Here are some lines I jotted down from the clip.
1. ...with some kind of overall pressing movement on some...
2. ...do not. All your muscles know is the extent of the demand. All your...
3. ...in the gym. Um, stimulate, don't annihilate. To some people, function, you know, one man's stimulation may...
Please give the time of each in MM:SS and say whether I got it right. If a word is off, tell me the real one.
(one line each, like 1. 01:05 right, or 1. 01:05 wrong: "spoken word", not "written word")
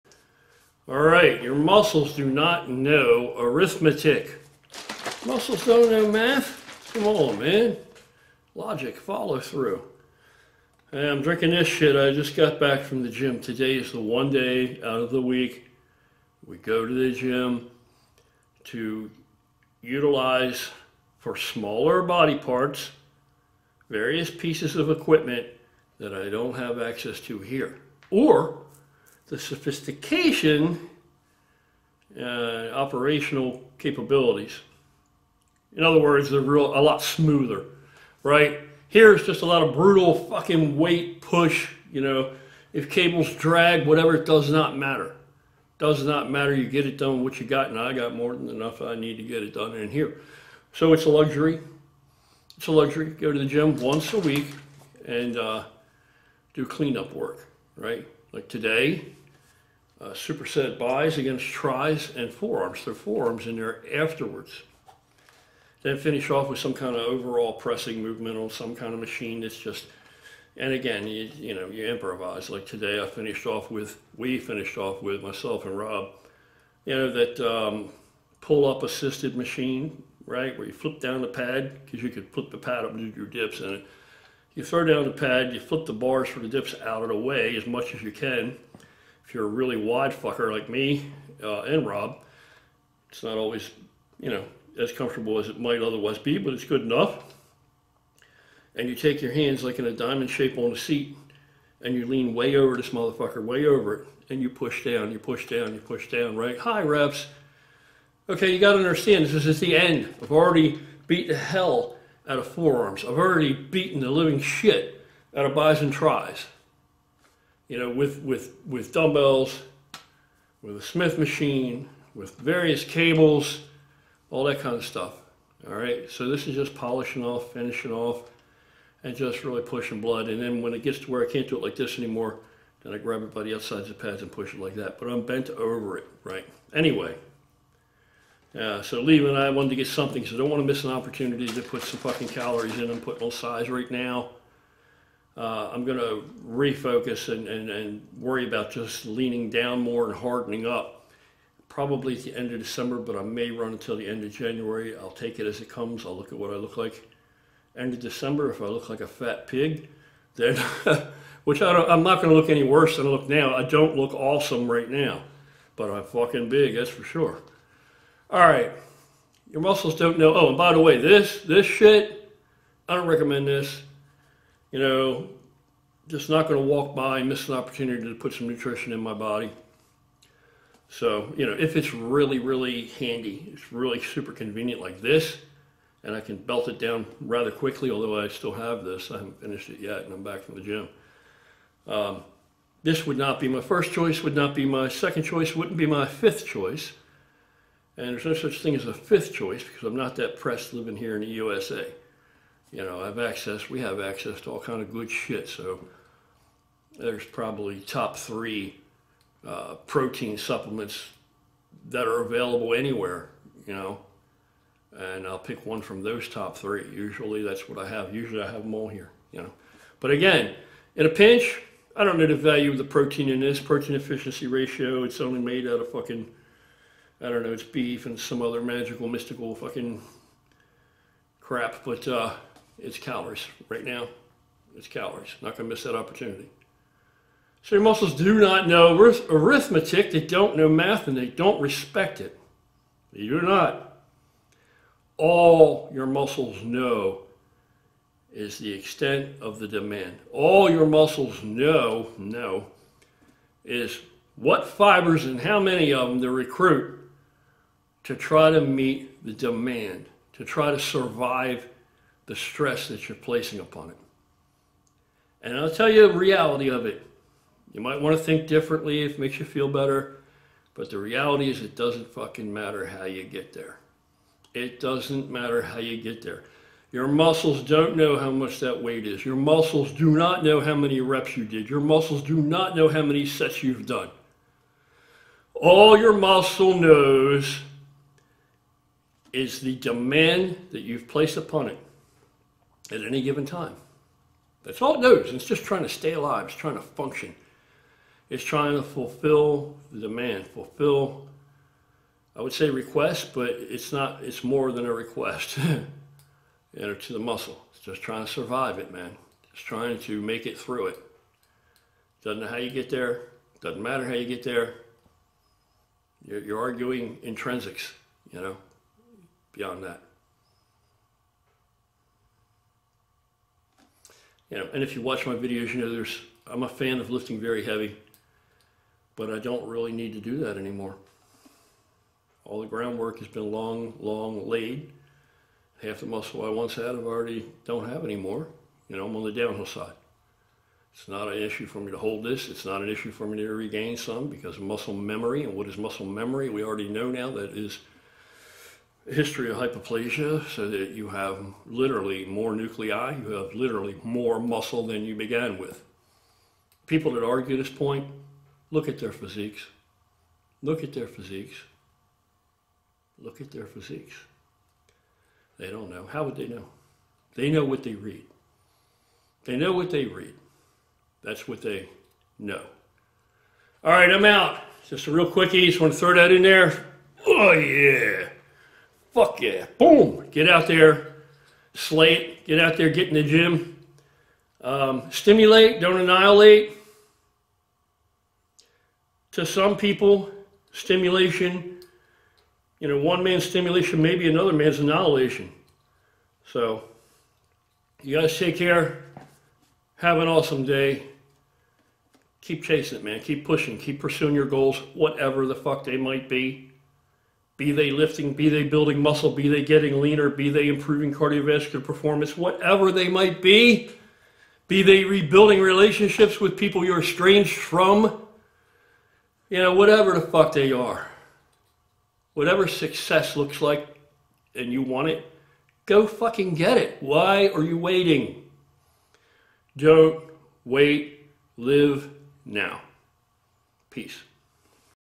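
1. 01:06 right
2. 04:03 right
3. 06:23 wrong: "stimulation", not "function".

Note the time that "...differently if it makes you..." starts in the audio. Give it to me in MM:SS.
04:28.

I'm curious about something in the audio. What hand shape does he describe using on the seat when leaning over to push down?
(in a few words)
Diamond shape.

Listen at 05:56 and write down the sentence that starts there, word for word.
People that argue this point, look at their physiques.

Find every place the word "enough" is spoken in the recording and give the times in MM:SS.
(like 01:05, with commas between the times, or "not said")
00:48, 01:36.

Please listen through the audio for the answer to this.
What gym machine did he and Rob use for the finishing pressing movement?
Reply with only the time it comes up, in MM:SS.
01:18.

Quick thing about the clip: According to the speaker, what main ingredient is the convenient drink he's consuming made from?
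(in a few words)
Beef.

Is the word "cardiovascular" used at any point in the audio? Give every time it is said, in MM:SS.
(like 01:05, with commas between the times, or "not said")
06:51.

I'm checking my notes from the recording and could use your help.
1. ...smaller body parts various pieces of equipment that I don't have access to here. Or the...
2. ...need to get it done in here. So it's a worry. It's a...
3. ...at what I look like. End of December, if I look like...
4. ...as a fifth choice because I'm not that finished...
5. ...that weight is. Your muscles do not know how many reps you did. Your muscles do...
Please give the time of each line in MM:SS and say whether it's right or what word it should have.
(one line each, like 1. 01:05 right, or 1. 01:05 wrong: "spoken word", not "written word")
1. 00:21 right
2. 00:48 wrong: "luxury", not "worry"
3. 02:36 right
4. 03:18 wrong: "pressed", not "finished"
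5. 04:38 right.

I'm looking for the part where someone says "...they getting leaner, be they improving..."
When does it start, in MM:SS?
06:49.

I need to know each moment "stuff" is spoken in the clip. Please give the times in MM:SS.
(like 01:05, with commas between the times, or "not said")
02:04.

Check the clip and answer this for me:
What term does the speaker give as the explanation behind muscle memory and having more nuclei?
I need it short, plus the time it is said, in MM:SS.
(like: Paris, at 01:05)
Hyperplasia, at 05:49.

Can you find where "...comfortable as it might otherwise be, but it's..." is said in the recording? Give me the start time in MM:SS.
01:34.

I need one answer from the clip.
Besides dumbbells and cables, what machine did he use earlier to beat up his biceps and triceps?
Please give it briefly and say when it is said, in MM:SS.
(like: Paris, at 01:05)
Smith machine, at 02:00.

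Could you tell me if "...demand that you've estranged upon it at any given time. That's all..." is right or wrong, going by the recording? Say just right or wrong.
wrong.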